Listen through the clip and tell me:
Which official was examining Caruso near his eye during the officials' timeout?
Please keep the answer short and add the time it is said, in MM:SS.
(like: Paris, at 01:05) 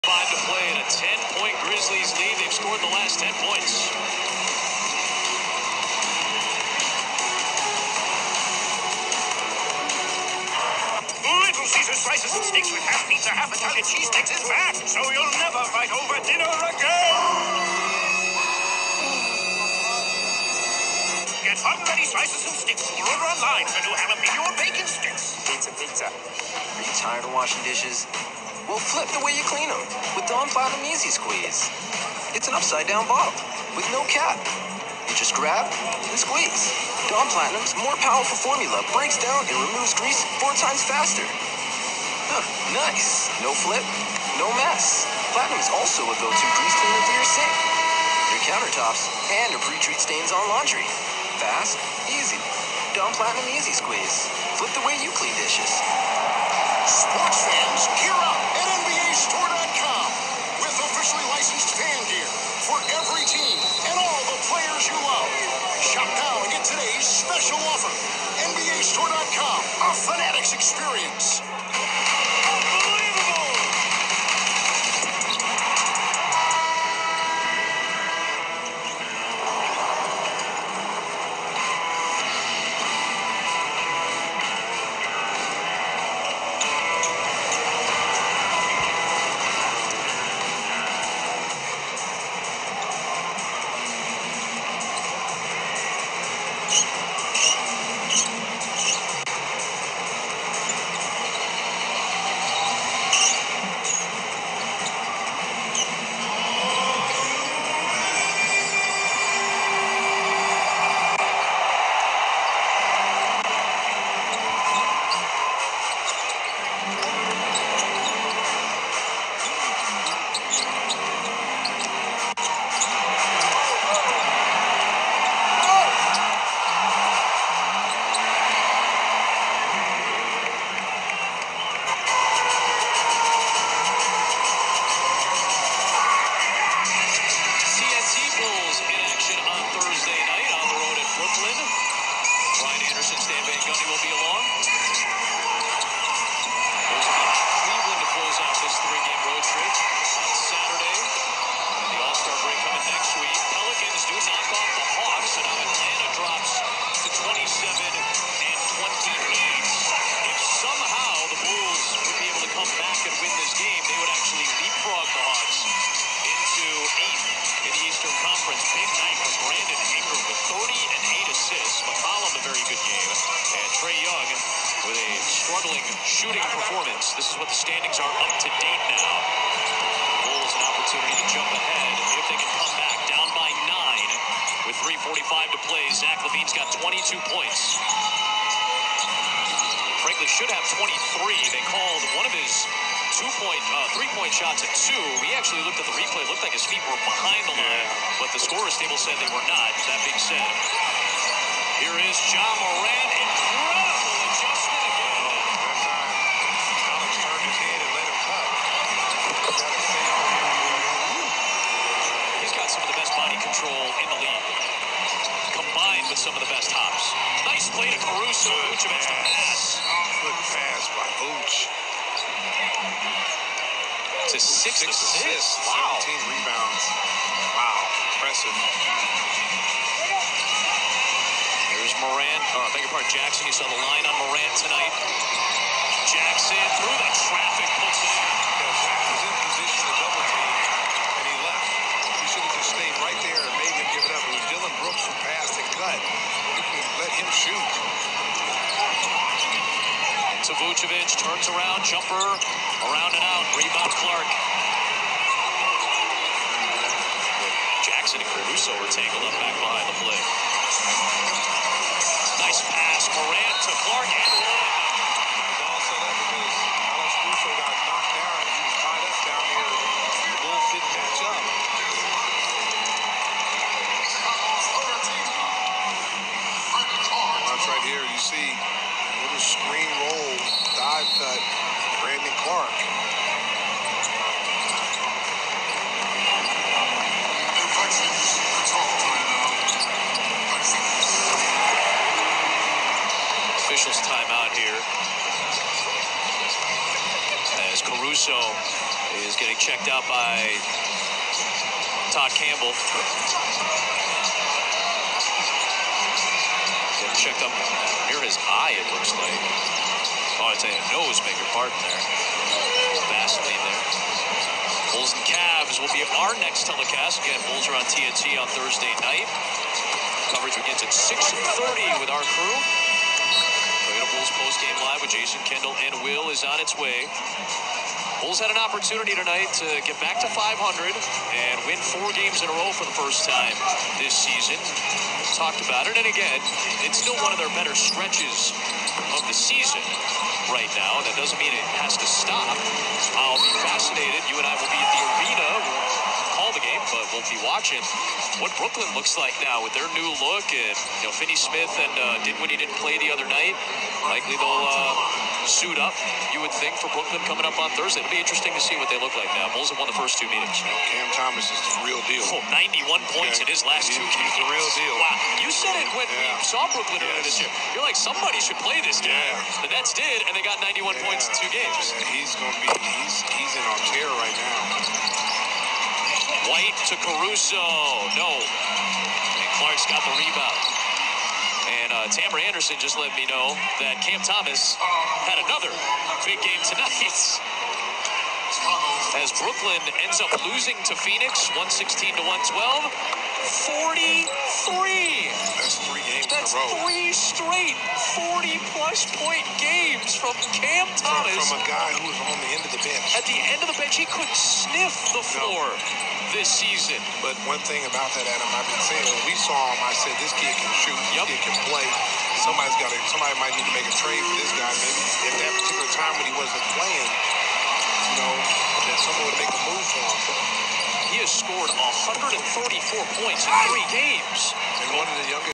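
Todd Campbell, at 05:02.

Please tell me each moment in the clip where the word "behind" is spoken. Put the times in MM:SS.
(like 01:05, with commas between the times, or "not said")
03:17, 04:19.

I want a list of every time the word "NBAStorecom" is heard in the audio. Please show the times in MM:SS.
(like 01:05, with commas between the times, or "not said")
00:58, 01:08.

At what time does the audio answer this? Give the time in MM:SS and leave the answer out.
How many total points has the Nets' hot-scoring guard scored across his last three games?
07:01.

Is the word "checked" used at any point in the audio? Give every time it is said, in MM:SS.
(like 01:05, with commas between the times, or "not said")
04:59, 05:07.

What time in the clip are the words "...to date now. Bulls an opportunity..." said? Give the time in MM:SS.
02:58.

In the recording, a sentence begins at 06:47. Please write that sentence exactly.
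But one thing about that, Adam, I've been saying when we saw him, I said this kid can shoot, yep.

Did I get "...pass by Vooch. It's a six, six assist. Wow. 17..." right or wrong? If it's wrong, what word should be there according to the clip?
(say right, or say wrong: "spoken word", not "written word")
right.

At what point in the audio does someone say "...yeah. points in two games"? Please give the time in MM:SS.
06:10.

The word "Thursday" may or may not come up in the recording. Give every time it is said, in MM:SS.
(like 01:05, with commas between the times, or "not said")
05:18, 05:57.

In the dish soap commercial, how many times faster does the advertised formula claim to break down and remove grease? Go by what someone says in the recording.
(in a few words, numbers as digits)
4.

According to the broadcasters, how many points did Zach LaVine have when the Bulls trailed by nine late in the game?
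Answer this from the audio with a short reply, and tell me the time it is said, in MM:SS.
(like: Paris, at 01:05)
22, at 03:06.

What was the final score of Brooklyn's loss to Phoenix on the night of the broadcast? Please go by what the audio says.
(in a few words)
116 to 112.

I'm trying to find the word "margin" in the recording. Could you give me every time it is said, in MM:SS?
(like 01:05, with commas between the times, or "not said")
not said.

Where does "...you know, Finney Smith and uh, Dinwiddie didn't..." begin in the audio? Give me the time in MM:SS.
05:51.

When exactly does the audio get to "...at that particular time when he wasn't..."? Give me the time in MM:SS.
06:55.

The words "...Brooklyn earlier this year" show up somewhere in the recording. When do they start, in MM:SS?
06:06.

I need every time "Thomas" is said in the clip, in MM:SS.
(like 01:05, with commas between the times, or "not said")
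06:01, 06:24, 06:40.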